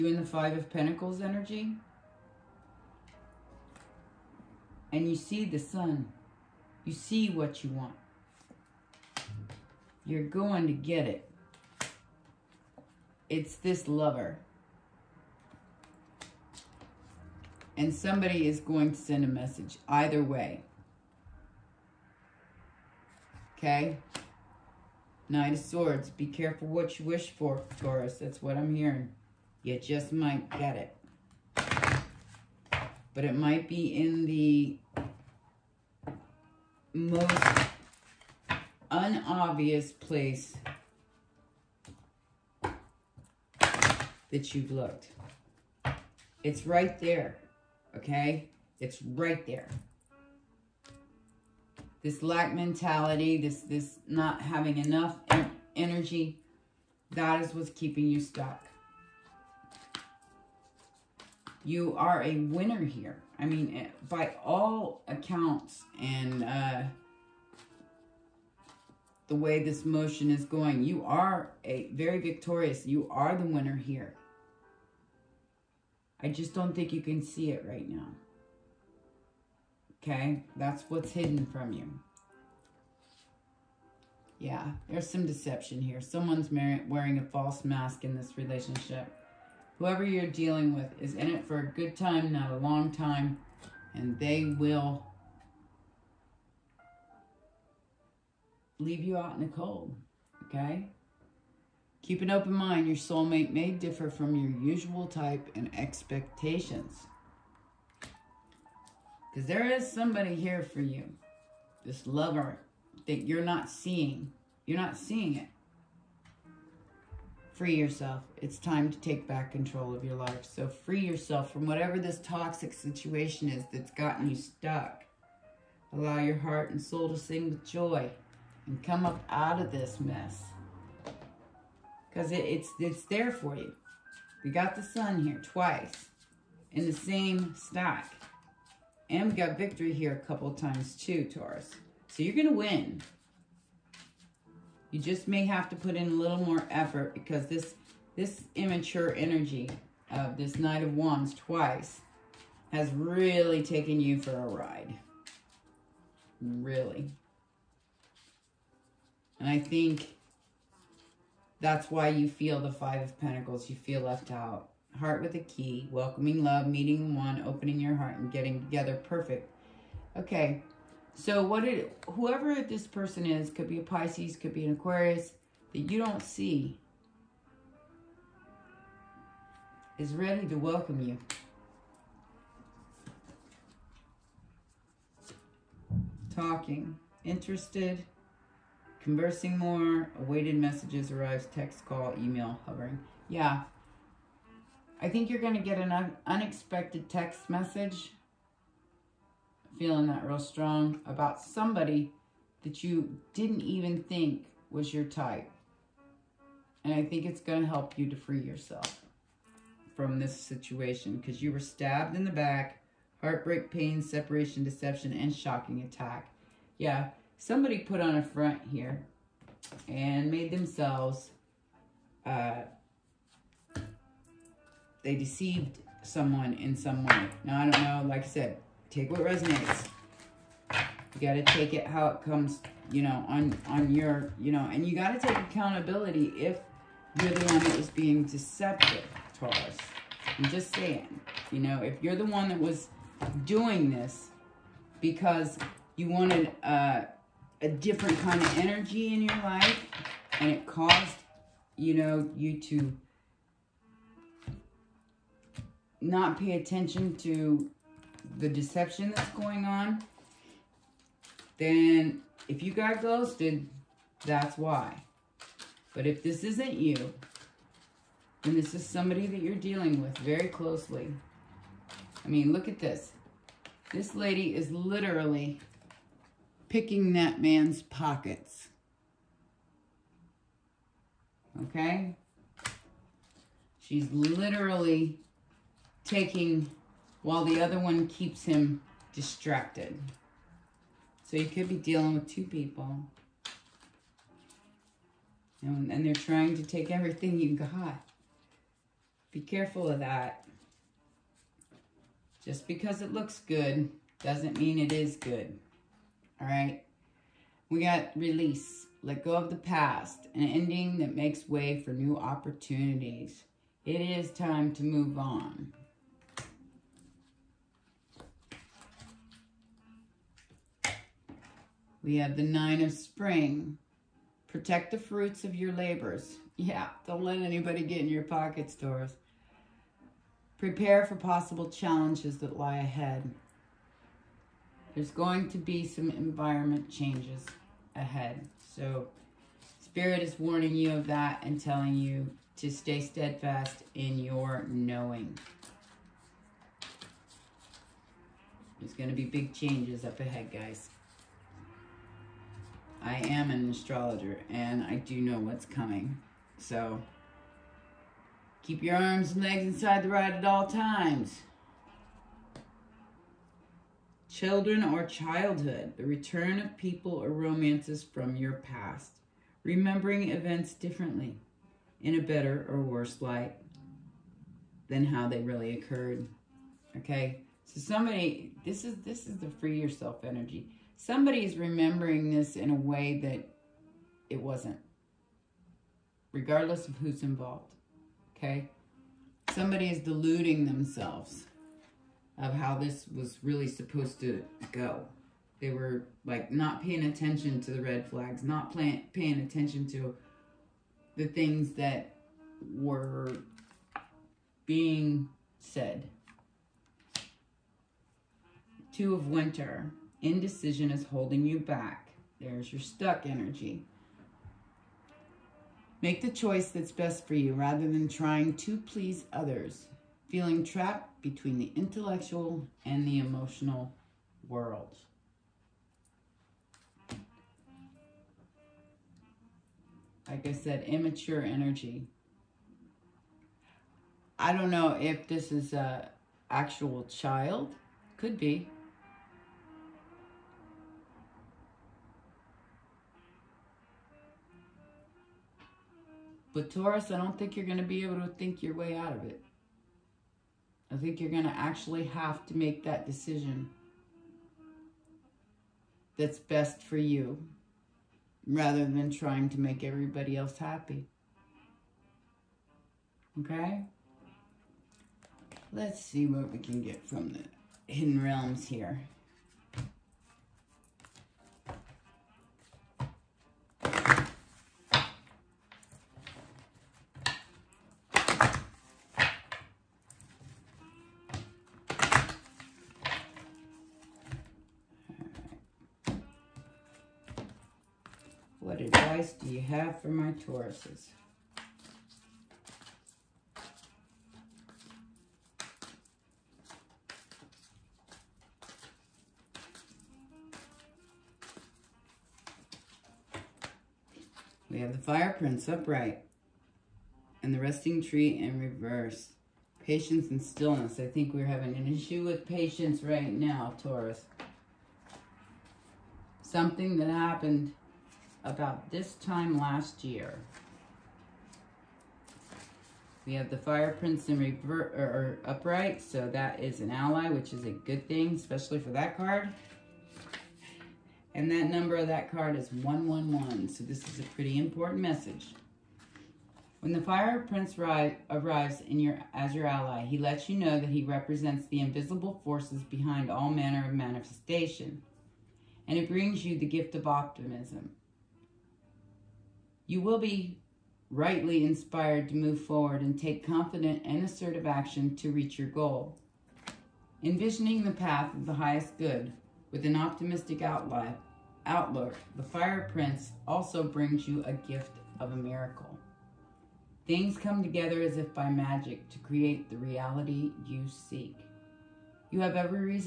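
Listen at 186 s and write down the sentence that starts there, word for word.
Talking, interested, Conversing more, awaited messages arrives, text, call, email, hovering.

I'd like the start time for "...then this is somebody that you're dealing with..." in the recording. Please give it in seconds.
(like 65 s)
268 s.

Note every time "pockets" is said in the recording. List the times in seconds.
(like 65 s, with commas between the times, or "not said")
277 s, 328 s.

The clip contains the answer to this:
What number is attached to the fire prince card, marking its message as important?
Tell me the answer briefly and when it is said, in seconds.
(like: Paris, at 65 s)
111, at 532 s.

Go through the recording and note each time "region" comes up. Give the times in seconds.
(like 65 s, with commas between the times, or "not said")
not said.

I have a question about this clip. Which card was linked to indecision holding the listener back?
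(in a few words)
Two of Winter.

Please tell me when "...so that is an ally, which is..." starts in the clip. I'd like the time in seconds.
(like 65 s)
526 s.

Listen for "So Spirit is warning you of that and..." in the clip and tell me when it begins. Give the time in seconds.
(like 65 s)
338 s.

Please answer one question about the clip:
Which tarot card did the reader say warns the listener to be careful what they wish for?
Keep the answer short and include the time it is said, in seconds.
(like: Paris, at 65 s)
Knight of Swords, at 25 s.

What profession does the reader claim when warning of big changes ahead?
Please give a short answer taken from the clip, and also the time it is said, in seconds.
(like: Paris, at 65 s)
Astrologer, at 353 s.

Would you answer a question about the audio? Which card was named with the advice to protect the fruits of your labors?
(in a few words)
Nine of Spring.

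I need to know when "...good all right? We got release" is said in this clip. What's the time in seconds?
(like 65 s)
305 s.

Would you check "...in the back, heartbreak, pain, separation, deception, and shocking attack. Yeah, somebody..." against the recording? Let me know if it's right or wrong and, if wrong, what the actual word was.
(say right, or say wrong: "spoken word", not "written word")
right.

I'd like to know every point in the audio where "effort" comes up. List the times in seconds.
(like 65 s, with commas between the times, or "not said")
146 s.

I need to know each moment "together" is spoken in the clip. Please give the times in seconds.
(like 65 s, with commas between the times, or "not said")
168 s, 567 s.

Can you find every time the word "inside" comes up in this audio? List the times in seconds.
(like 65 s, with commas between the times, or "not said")
359 s.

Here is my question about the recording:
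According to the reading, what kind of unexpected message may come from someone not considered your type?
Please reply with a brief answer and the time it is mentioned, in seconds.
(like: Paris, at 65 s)
Text message, at 197 s.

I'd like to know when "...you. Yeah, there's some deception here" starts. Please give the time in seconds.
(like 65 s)
81 s.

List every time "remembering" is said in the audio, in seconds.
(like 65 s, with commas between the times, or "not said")
369 s, 381 s.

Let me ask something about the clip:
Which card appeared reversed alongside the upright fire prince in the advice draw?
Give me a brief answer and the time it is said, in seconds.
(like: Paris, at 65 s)
Resting tree, at 507 s.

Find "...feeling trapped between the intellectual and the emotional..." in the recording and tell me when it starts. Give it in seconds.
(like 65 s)
420 s.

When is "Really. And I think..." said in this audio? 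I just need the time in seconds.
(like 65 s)
156 s.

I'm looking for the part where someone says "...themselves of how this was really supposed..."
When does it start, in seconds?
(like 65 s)
390 s.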